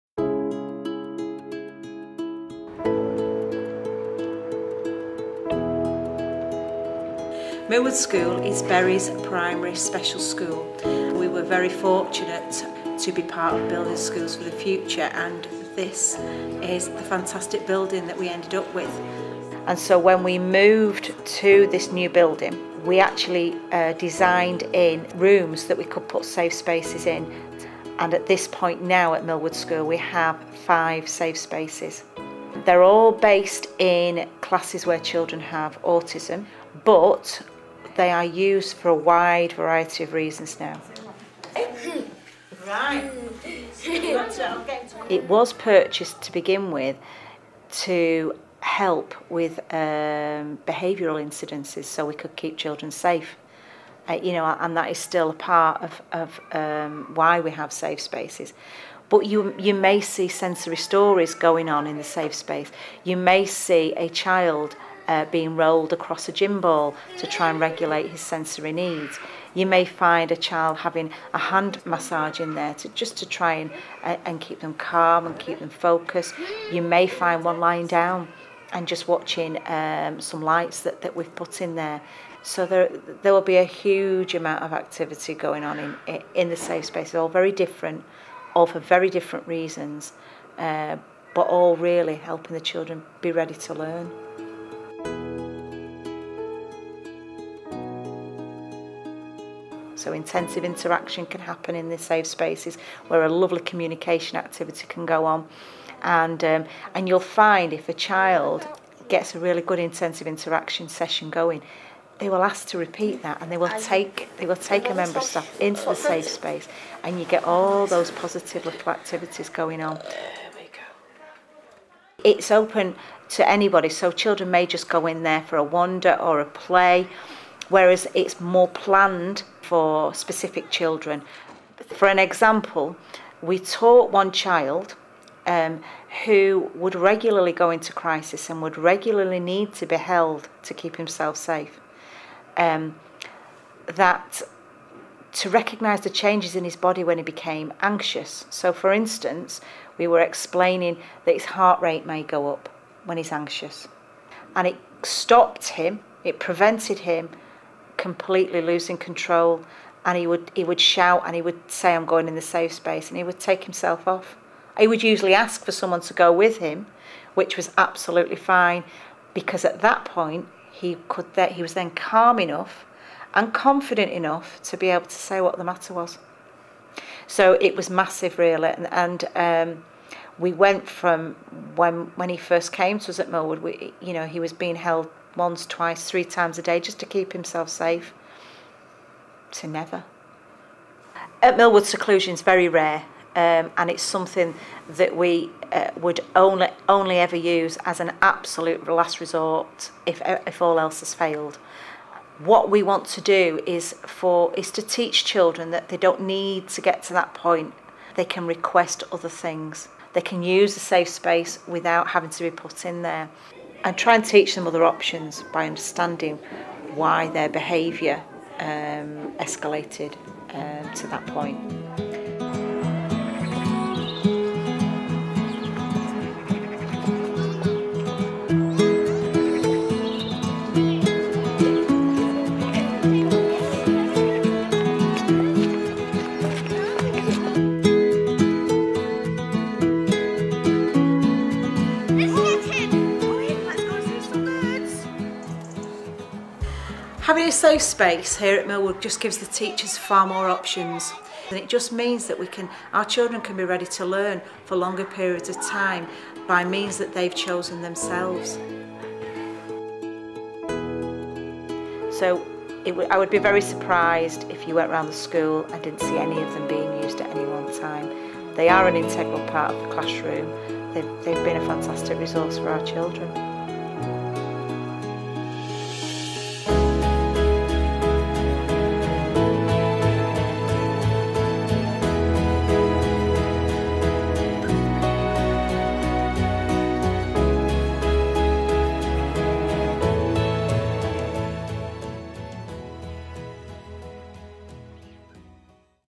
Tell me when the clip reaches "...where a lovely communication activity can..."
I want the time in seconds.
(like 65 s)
103 s.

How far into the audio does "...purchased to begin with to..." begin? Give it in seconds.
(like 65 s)
45 s.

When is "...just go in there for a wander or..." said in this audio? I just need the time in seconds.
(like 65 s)
124 s.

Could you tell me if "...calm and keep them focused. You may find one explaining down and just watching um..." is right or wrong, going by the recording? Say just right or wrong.
wrong.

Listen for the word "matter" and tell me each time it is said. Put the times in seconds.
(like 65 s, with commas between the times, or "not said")
175 s.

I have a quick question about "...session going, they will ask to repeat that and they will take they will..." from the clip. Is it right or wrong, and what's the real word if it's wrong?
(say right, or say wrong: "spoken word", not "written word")
right.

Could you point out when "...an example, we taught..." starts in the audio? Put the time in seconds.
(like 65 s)
132 s.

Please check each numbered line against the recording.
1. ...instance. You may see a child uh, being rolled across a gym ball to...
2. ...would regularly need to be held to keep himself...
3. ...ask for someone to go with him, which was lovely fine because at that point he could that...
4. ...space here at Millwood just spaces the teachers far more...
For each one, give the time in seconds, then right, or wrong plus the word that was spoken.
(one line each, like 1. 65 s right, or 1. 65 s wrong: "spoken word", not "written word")
1. 62 s wrong: "space", not "instance"
2. 138 s right
3. 165 s wrong: "absolutely", not "lovely"
4. 247 s wrong: "gives", not "spaces".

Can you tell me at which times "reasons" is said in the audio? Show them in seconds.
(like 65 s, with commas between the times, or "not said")
40 s, 89 s.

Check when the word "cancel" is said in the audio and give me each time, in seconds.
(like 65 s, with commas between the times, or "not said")
not said.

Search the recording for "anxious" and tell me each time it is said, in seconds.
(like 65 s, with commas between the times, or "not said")
147 s, 153 s.